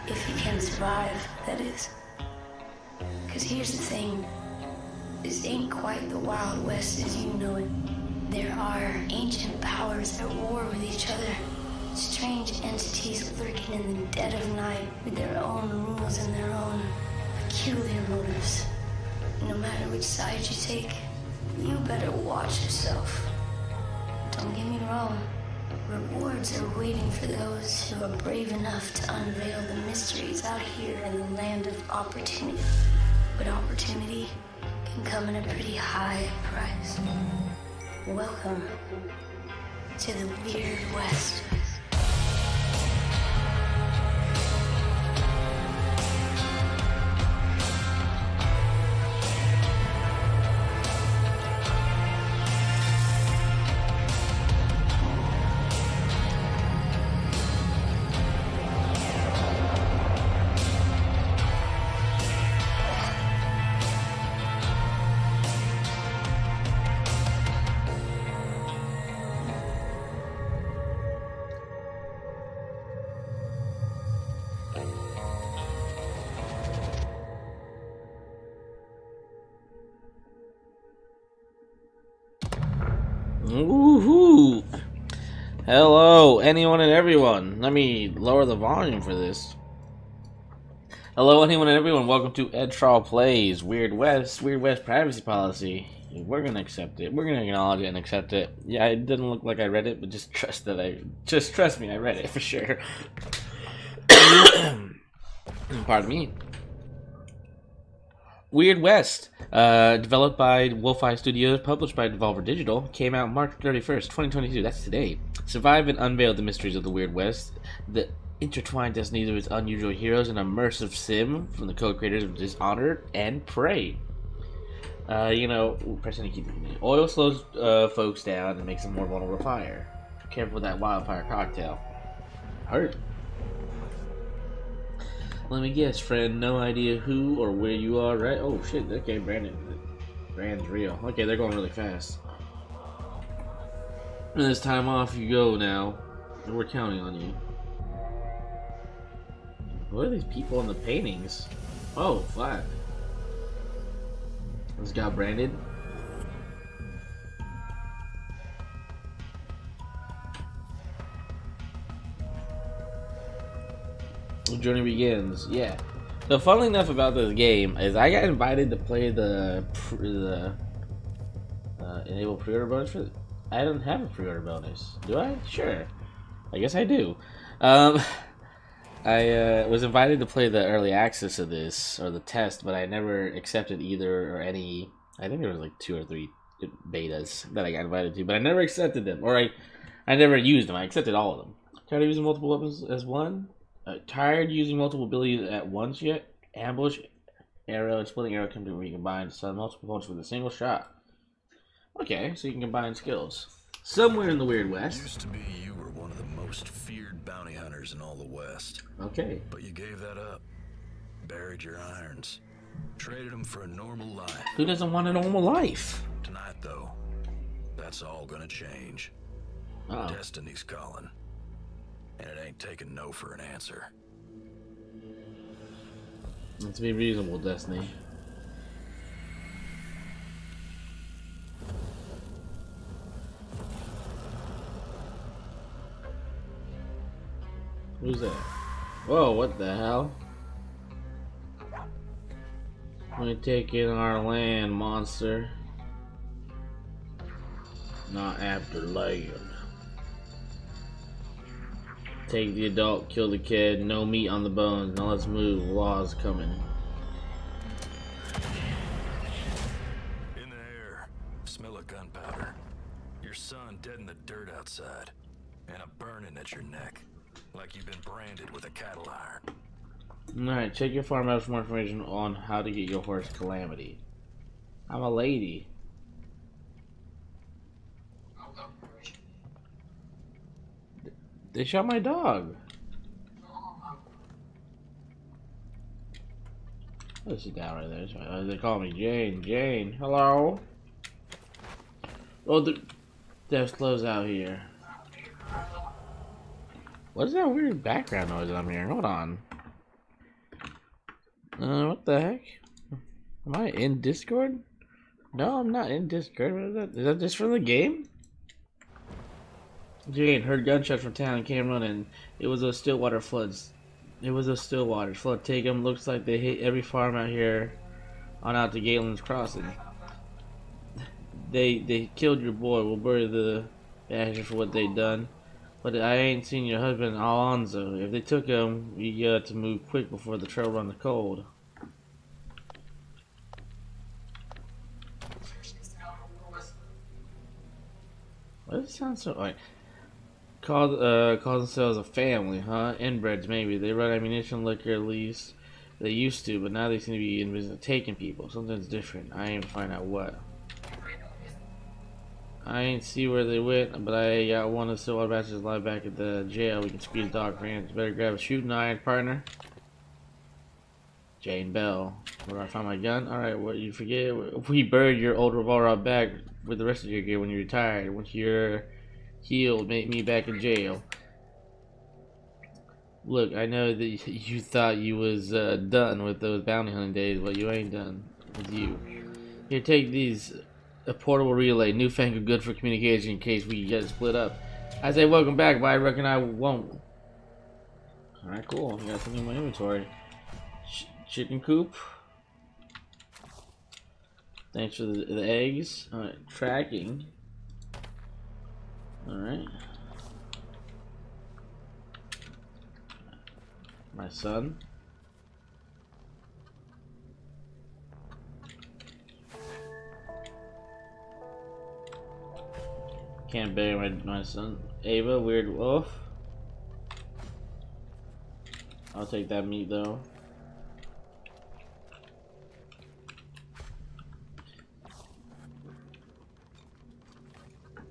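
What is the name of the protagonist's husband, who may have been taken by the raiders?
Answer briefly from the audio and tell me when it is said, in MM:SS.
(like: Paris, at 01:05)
Alonzo, at 05:27.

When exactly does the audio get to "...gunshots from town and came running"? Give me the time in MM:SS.
05:10.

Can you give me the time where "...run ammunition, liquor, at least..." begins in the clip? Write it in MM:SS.
05:43.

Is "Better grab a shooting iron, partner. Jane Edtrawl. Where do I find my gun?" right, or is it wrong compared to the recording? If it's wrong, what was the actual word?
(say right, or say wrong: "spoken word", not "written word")
wrong: "Bell", not "Edtrawl".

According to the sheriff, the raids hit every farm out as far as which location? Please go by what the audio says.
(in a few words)
Galen's Crossing.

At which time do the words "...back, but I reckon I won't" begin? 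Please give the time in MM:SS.
06:25.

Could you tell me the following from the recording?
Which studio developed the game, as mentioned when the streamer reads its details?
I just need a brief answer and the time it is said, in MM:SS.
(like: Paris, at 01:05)
Wolfeye Studios, at 01:50.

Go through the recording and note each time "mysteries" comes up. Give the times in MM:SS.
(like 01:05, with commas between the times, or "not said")
00:29, 01:56.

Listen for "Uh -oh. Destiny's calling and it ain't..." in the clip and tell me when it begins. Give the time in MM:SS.
03:39.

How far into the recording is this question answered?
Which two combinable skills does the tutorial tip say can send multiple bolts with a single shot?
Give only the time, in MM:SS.
03:16.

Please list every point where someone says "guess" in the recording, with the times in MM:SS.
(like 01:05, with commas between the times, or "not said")
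02:15, 02:56.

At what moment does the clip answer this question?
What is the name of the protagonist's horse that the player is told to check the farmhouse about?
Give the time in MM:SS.
04:33.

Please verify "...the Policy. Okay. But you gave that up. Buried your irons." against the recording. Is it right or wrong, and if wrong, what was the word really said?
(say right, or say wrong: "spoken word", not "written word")
wrong: "West", not "Policy".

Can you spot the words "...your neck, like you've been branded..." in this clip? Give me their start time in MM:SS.
04:26.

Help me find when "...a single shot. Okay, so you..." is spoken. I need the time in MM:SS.
03:20.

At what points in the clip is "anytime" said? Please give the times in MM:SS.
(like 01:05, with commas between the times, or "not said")
not said.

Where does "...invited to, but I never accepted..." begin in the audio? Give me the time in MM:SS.
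03:07.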